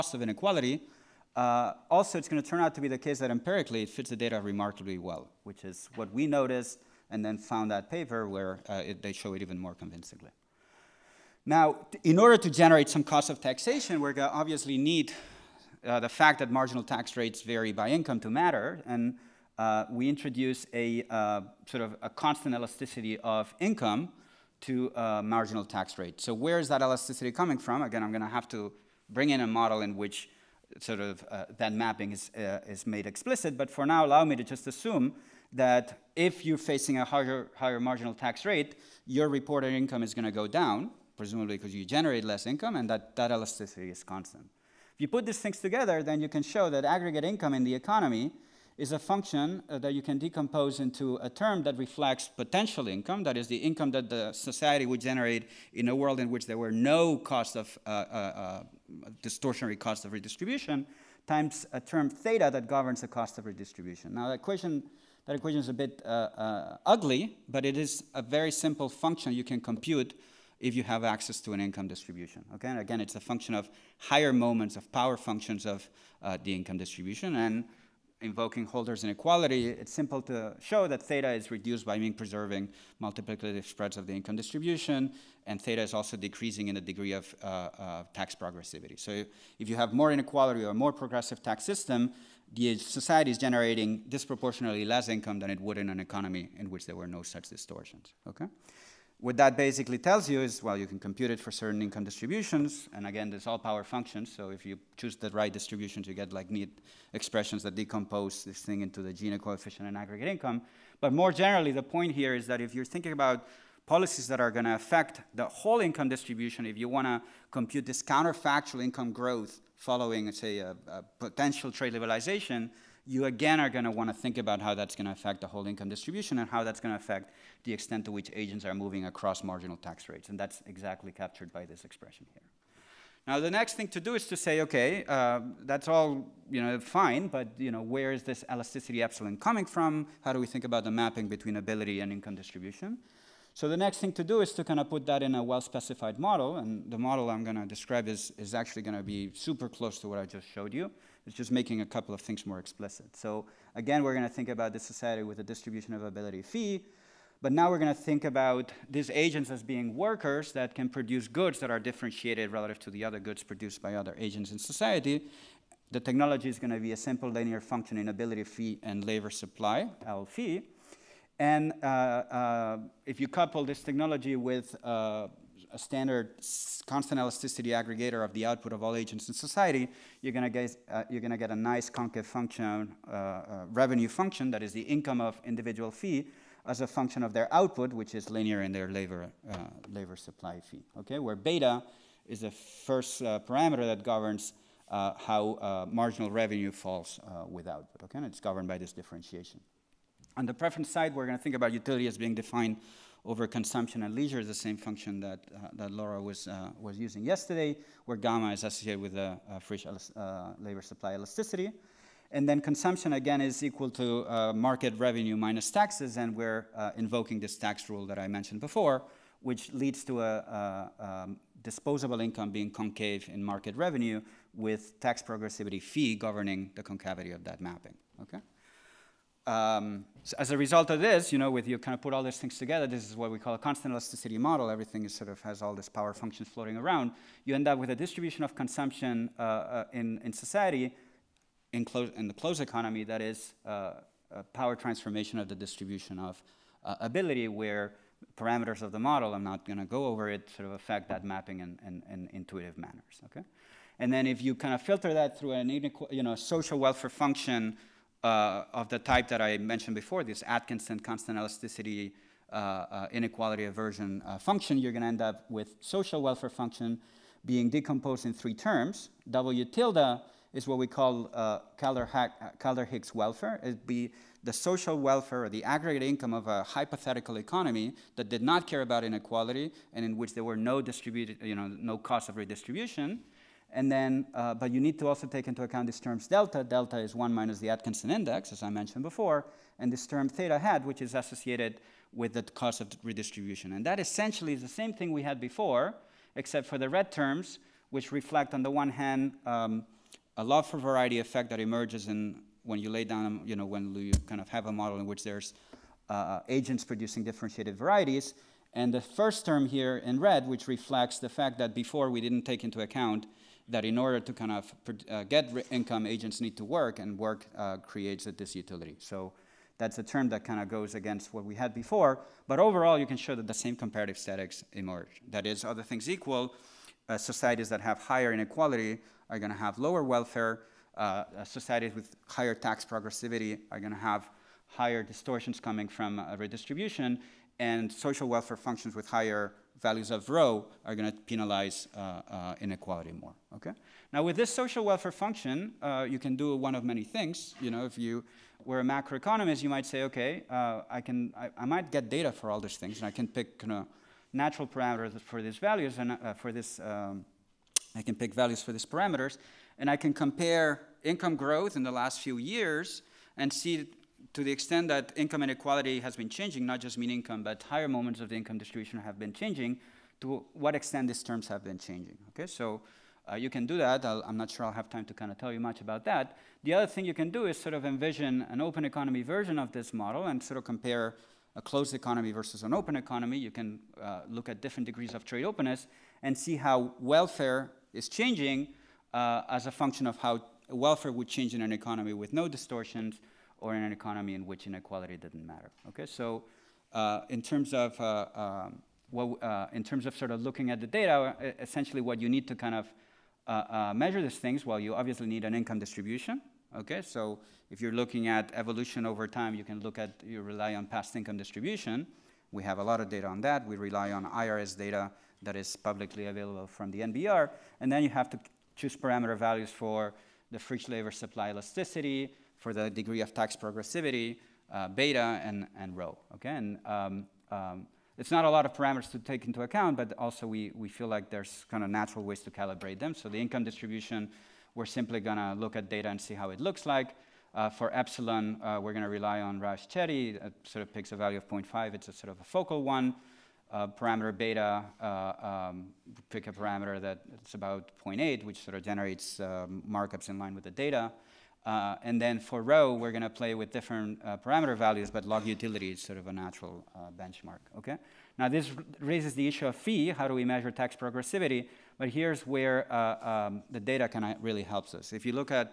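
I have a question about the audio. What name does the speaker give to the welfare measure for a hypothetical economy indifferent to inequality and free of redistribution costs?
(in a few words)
Kaldor-Hicks welfare.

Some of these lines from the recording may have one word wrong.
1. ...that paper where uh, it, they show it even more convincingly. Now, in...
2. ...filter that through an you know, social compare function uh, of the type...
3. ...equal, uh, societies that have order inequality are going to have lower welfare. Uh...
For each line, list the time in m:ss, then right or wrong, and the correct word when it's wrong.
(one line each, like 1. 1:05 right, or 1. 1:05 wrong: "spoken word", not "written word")
1. 0:07 right
2. 4:14 wrong: "welfare", not "compare"
3. 5:26 wrong: "higher", not "order".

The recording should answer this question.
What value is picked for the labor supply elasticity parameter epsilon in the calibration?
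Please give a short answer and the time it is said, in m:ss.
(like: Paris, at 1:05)
0.5, at 7:21.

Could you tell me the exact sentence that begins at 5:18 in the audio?
So that's a term that kind of goes against what we had before.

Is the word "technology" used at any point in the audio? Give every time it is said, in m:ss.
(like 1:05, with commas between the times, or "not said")
2:46, 2:53.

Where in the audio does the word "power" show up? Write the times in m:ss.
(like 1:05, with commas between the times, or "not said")
1:14, 1:43, 3:55, 4:04.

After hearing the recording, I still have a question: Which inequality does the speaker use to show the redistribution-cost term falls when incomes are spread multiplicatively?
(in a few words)
Hölder's inequality.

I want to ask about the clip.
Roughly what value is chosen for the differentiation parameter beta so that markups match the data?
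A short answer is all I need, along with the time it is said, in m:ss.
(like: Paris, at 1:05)
0.8, at 7:28.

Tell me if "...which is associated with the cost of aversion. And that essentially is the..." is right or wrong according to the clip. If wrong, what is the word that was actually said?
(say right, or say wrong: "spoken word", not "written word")
wrong: "redistribution", not "aversion".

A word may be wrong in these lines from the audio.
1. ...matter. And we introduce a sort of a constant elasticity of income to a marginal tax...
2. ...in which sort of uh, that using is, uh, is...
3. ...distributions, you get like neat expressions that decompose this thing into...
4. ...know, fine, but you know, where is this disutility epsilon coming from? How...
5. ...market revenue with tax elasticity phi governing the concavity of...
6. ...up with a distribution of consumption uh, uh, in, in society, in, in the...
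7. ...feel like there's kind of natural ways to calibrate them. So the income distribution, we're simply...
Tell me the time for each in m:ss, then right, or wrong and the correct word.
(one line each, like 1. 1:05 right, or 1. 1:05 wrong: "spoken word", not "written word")
1. 0:18 right
2. 0:29 wrong: "mapping", not "using"
3. 1:45 right
4. 2:16 wrong: "elasticity", not "disutility"
5. 3:43 wrong: "progressivity", not "elasticity"
6. 3:57 right
7. 7:10 right.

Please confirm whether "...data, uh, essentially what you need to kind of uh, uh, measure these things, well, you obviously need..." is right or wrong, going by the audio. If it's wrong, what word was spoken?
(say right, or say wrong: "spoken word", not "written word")
right.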